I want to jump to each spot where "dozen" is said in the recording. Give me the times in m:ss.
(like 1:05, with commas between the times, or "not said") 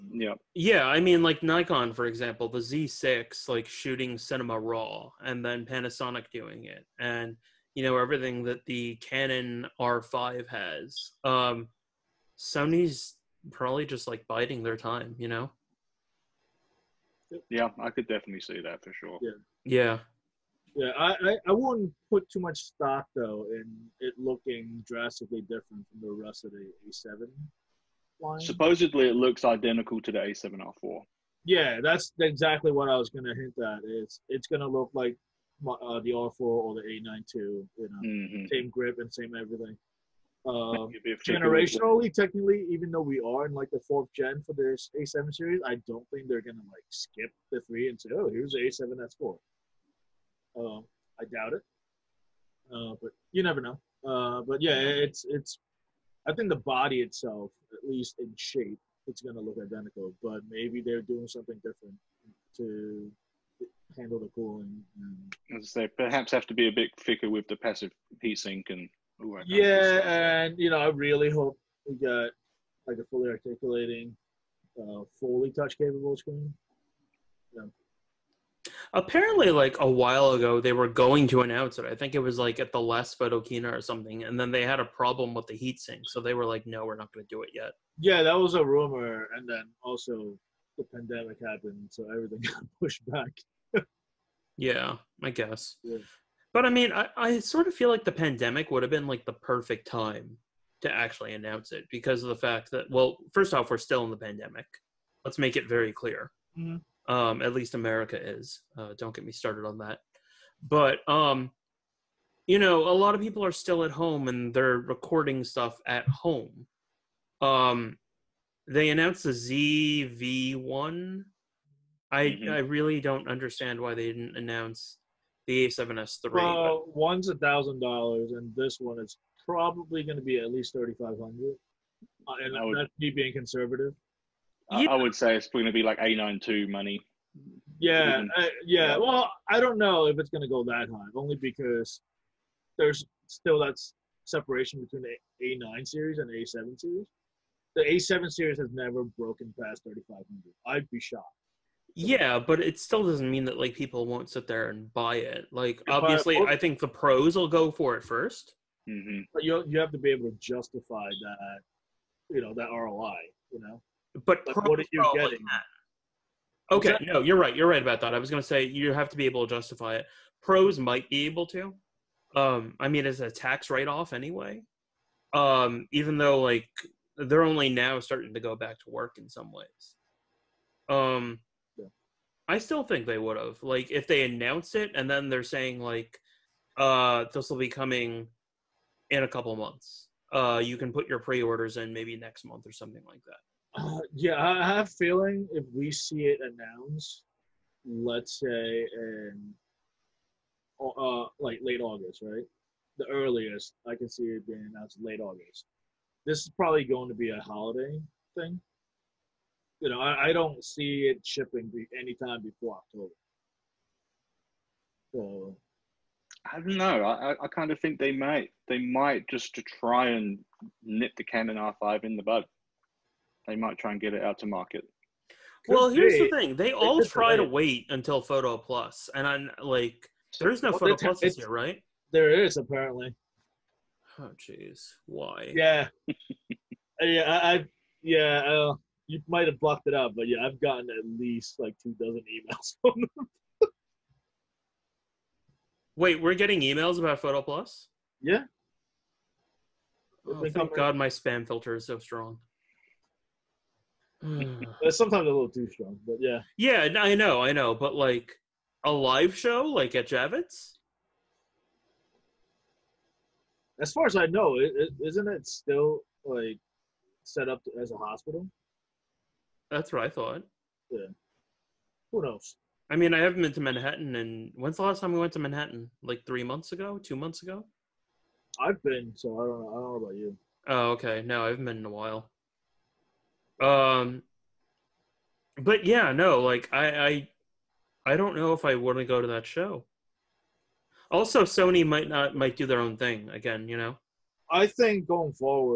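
4:01.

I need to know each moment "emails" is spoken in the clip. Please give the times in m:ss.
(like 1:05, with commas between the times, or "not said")
4:02, 4:06.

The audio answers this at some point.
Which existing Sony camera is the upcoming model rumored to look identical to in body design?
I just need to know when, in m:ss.
0:30.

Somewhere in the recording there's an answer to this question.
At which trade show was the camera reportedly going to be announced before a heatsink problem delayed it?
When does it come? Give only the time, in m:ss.
1:23.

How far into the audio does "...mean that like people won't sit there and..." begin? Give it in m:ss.
2:33.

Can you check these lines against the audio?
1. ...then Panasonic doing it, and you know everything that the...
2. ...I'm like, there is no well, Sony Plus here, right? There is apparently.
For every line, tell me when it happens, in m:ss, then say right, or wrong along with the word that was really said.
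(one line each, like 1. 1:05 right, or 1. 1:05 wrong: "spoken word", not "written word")
1. 0:05 right
2. 3:49 wrong: "Photo", not "Sony".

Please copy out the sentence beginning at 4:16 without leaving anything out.
Yeah, I know, I know, but like a live show like at Javits?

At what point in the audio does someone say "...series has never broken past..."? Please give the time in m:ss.
2:28.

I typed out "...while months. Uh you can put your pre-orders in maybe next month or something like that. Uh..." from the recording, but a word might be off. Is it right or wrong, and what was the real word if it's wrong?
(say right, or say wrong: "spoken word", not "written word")
wrong: "couple", not "while".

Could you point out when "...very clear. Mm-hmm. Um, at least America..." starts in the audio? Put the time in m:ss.
1:45.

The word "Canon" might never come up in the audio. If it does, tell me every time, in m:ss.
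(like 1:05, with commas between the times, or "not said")
0:09, 3:41.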